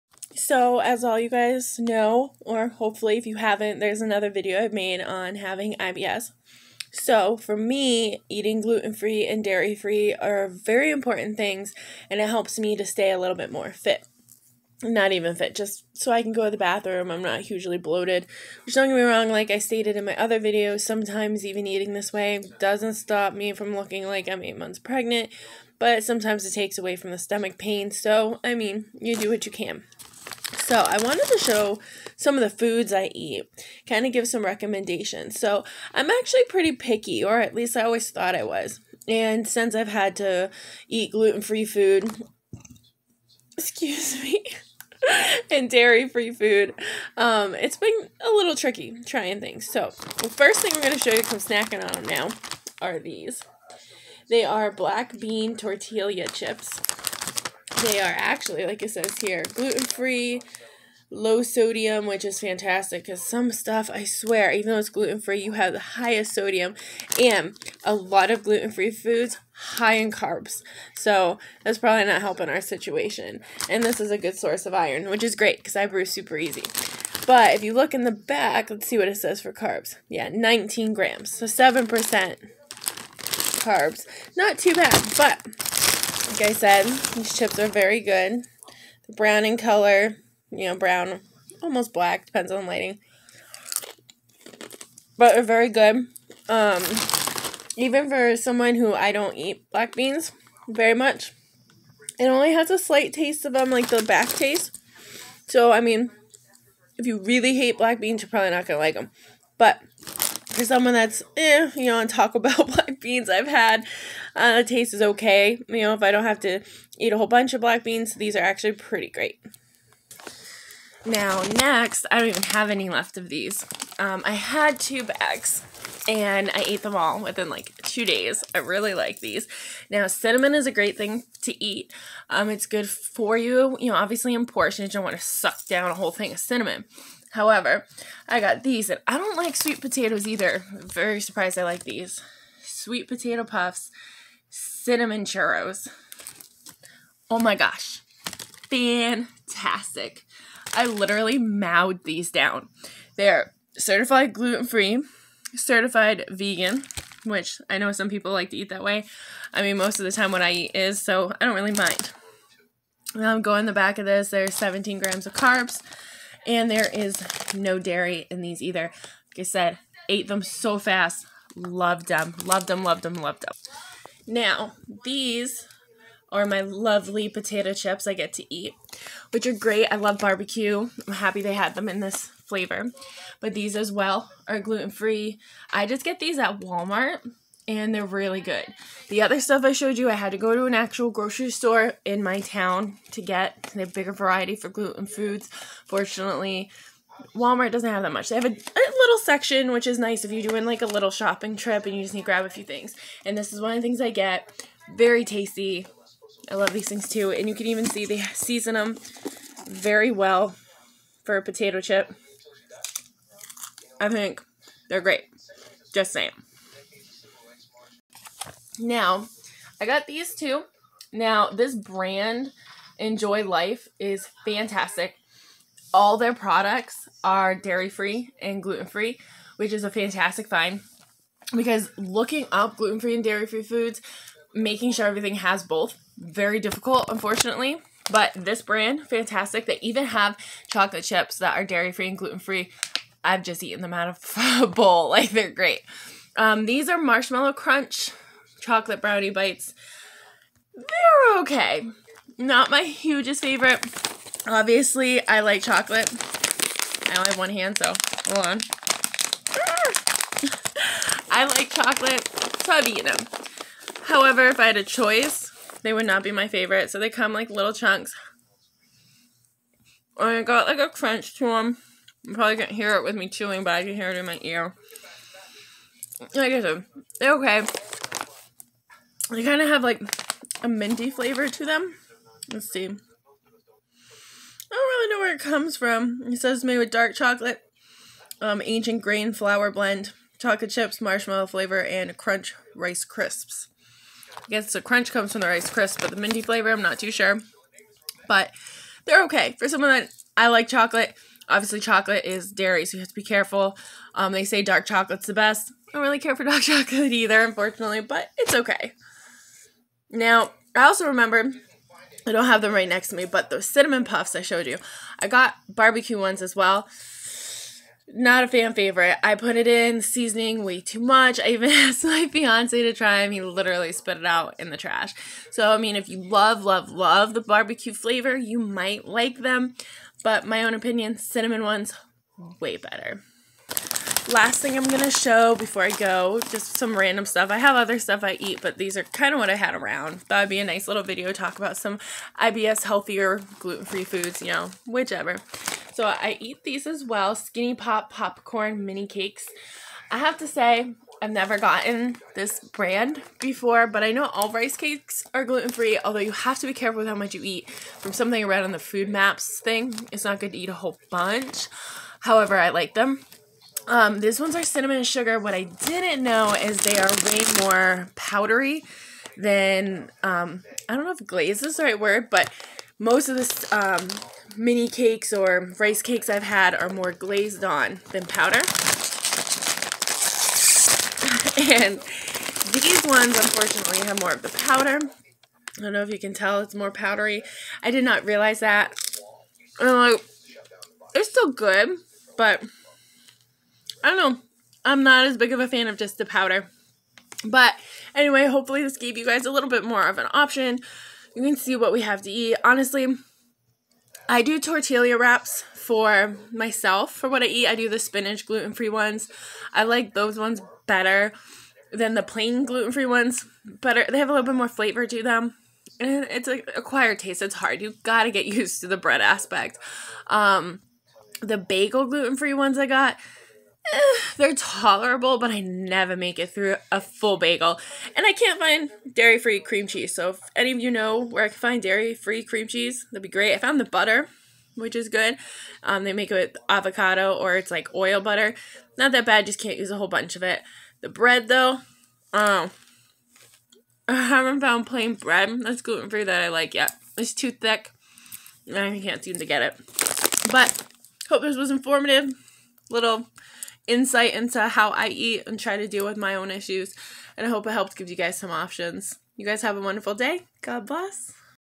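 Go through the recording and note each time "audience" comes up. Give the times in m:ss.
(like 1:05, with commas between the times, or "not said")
not said.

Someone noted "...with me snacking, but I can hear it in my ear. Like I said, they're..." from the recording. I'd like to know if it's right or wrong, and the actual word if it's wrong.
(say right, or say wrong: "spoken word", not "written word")
wrong: "chewing", not "snacking".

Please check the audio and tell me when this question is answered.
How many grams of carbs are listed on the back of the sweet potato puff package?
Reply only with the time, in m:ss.
2:44.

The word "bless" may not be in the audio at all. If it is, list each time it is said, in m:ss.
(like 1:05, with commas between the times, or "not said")
7:40.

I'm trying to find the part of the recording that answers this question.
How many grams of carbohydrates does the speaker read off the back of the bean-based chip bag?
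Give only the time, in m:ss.
1:20.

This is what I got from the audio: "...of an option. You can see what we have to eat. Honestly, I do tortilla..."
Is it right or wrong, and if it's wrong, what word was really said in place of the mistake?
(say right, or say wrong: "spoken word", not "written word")
right.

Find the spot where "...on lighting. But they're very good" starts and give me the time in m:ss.
1:32.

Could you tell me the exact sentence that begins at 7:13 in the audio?
I found the butter, which is good.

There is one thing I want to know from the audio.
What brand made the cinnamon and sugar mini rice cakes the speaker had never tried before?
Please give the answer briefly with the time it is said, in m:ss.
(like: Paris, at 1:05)
Skinny Pop, at 5:47.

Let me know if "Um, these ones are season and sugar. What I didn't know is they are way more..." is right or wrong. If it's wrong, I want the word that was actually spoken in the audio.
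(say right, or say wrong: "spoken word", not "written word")
wrong: "cinnamon", not "season".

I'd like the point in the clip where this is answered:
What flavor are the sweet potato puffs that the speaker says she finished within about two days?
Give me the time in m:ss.
2:24.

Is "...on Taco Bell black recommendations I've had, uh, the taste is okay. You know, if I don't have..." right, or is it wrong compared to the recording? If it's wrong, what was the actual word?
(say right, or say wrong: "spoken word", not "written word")
wrong: "beans", not "recommendations".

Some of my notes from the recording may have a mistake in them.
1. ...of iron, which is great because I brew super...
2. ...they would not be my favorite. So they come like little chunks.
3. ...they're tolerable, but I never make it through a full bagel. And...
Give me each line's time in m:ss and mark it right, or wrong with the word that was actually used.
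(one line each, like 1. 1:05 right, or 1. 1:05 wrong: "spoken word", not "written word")
1. 1:14 right
2. 4:25 right
3. 7:04 right.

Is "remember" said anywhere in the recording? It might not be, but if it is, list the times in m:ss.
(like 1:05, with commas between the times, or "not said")
5:11.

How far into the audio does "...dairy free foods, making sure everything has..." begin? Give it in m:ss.
3:53.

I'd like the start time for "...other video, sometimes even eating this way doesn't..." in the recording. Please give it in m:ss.
0:20.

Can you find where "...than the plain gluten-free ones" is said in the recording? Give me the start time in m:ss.
6:51.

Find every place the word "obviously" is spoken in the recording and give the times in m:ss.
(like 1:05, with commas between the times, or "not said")
2:13, 4:14, 5:01.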